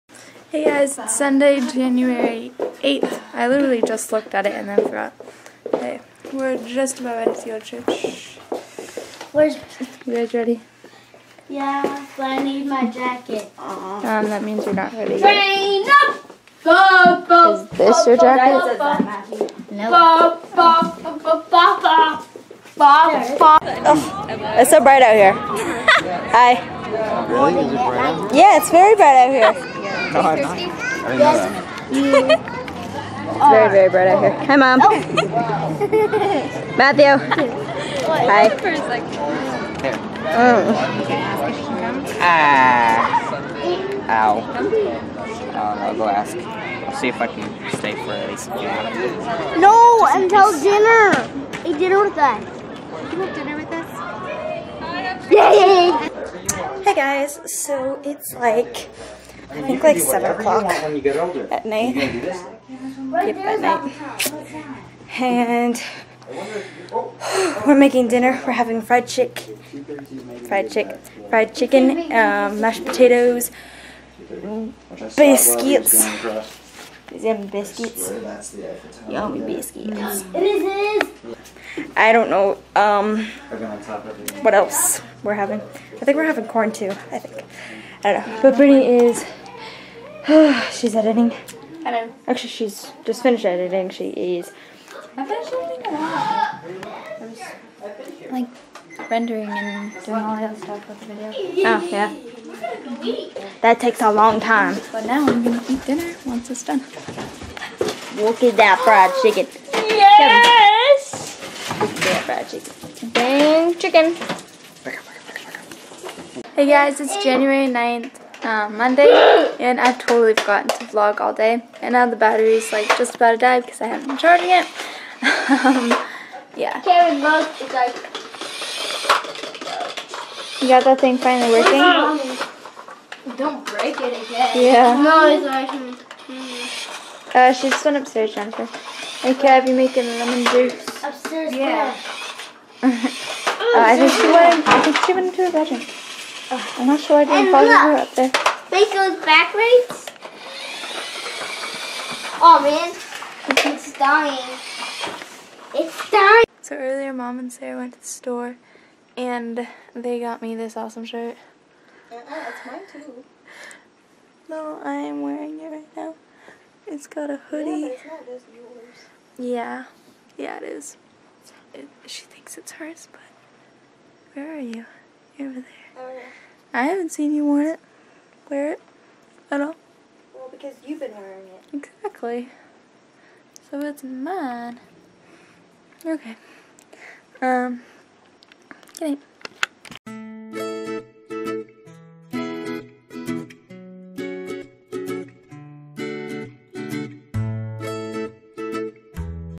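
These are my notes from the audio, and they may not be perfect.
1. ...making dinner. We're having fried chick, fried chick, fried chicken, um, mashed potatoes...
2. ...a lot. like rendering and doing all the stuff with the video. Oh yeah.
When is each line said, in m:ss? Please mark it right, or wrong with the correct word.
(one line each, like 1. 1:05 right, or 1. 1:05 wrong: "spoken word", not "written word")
1. 1:07 right
2. 1:38 right.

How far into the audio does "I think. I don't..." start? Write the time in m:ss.
1:27.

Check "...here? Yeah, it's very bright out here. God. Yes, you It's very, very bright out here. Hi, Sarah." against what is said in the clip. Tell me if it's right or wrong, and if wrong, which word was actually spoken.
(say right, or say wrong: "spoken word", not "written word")
wrong: "Mom", not "Sarah".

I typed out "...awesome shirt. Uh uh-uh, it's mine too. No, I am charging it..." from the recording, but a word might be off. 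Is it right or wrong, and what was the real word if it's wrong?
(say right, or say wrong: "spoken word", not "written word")
wrong: "wearing", not "charging".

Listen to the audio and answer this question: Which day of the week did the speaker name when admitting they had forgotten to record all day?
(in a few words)
Monday.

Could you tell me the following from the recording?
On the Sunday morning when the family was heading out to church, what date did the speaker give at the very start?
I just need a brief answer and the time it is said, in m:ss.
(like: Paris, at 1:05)
January 8th, at 0:01.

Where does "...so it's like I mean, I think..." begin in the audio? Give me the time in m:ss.
0:57.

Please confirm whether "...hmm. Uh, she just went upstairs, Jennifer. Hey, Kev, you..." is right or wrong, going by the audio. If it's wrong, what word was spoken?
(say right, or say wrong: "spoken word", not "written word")
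right.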